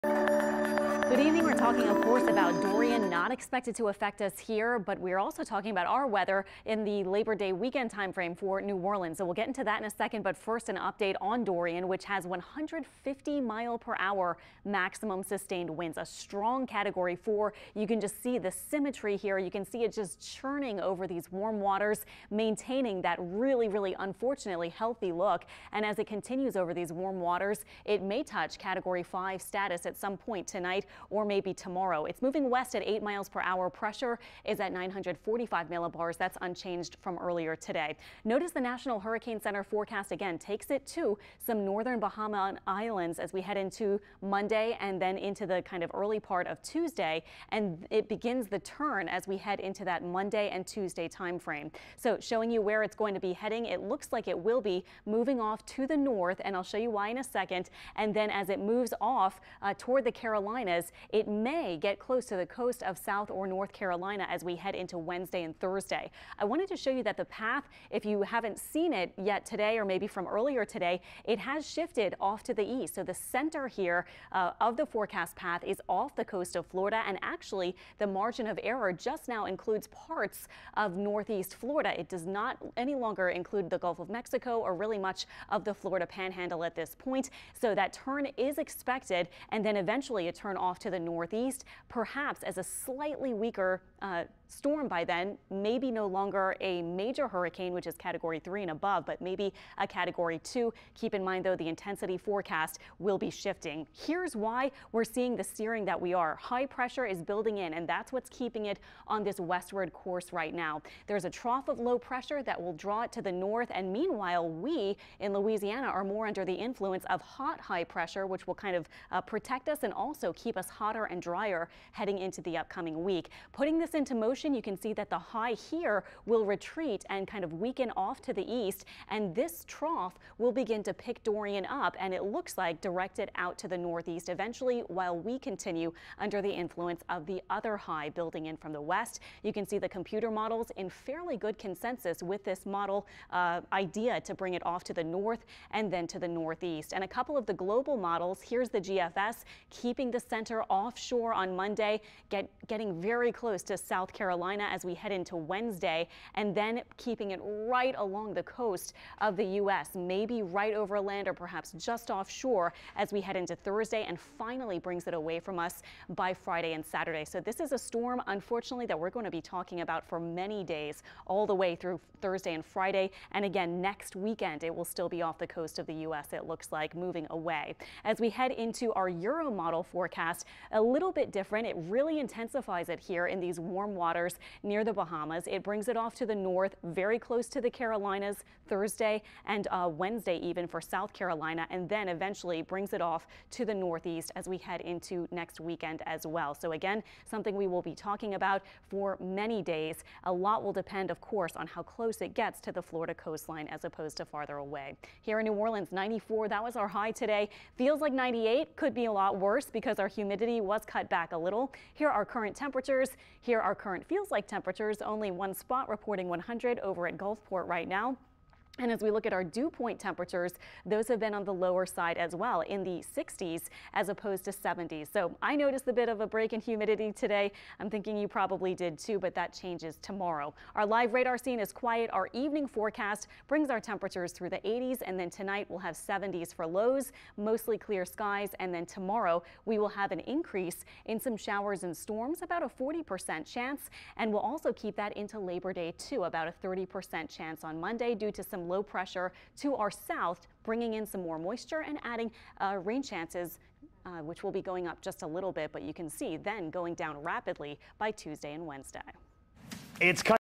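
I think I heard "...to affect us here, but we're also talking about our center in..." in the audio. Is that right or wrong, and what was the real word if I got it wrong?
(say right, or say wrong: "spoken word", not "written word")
wrong: "weather", not "center".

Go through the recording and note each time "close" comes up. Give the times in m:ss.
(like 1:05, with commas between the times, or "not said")
1:01, 2:33, 3:07, 3:21.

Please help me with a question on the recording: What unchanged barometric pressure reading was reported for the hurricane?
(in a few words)
945 millibars.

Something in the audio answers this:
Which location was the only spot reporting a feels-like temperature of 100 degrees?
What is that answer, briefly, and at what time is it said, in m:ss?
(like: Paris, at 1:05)
Gulfport, at 3:37.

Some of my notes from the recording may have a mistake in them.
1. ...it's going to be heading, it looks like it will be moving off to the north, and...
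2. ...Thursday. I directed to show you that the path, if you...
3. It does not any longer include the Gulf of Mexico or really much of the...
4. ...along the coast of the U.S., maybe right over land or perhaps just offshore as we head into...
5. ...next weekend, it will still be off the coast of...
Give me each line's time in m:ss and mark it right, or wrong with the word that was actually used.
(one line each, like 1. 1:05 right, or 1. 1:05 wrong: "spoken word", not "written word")
1. 0:52 right
2. 1:05 wrong: "wanted", not "directed"
3. 1:21 right
4. 2:37 right
5. 2:53 right.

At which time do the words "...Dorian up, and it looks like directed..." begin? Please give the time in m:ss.
2:11.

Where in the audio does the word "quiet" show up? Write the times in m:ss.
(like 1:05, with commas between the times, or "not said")
3:51.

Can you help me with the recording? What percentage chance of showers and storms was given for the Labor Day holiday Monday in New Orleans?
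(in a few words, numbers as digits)
30%.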